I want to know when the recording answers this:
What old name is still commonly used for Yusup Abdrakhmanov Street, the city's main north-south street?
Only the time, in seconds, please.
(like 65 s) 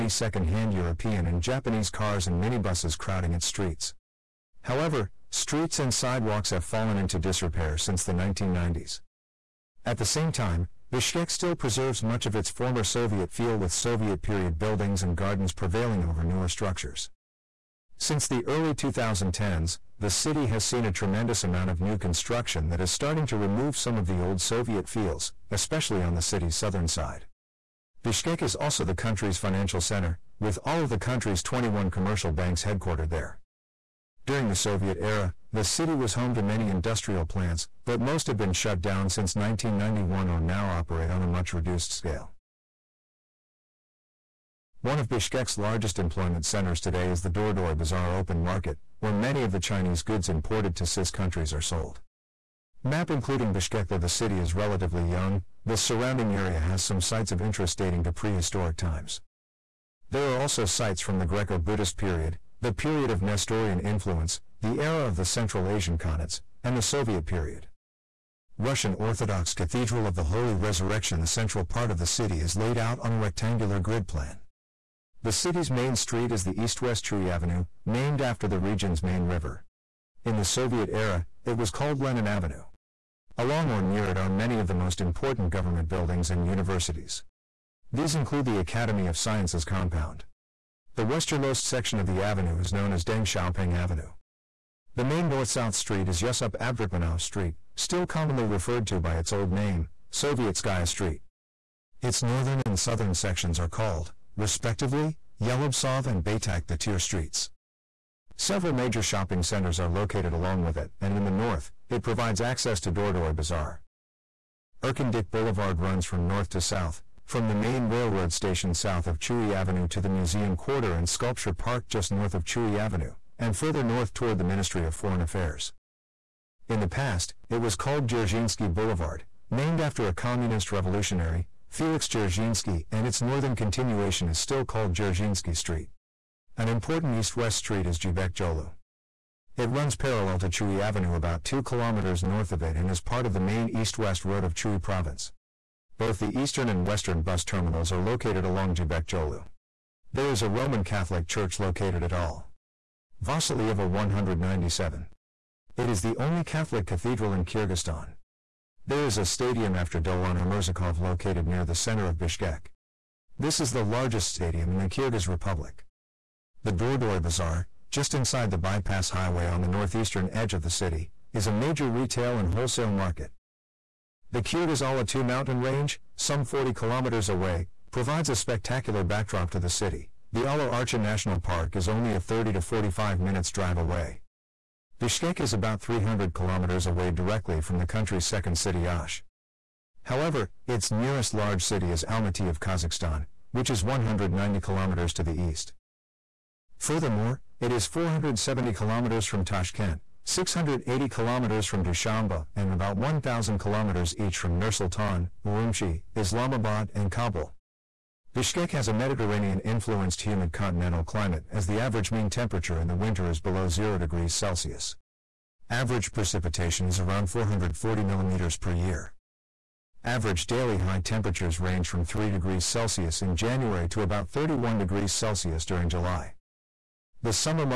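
100 s.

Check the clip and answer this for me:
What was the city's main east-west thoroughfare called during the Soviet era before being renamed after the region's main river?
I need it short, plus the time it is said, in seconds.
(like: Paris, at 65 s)
Lenin Avenue, at 82 s.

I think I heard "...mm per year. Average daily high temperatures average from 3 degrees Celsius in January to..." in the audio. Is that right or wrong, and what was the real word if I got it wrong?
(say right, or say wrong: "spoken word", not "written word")
wrong: "range", not "average".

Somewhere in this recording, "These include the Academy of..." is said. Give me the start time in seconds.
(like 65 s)
87 s.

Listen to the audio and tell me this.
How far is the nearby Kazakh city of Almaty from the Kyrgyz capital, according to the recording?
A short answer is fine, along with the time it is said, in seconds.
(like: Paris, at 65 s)
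190 kilometers, at 193 s.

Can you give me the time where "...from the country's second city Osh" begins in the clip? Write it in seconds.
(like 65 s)
187 s.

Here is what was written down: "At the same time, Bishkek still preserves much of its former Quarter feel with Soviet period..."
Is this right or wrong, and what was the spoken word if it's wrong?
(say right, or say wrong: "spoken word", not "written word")
wrong: "Soviet", not "Quarter".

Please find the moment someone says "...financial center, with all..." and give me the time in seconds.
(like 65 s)
29 s.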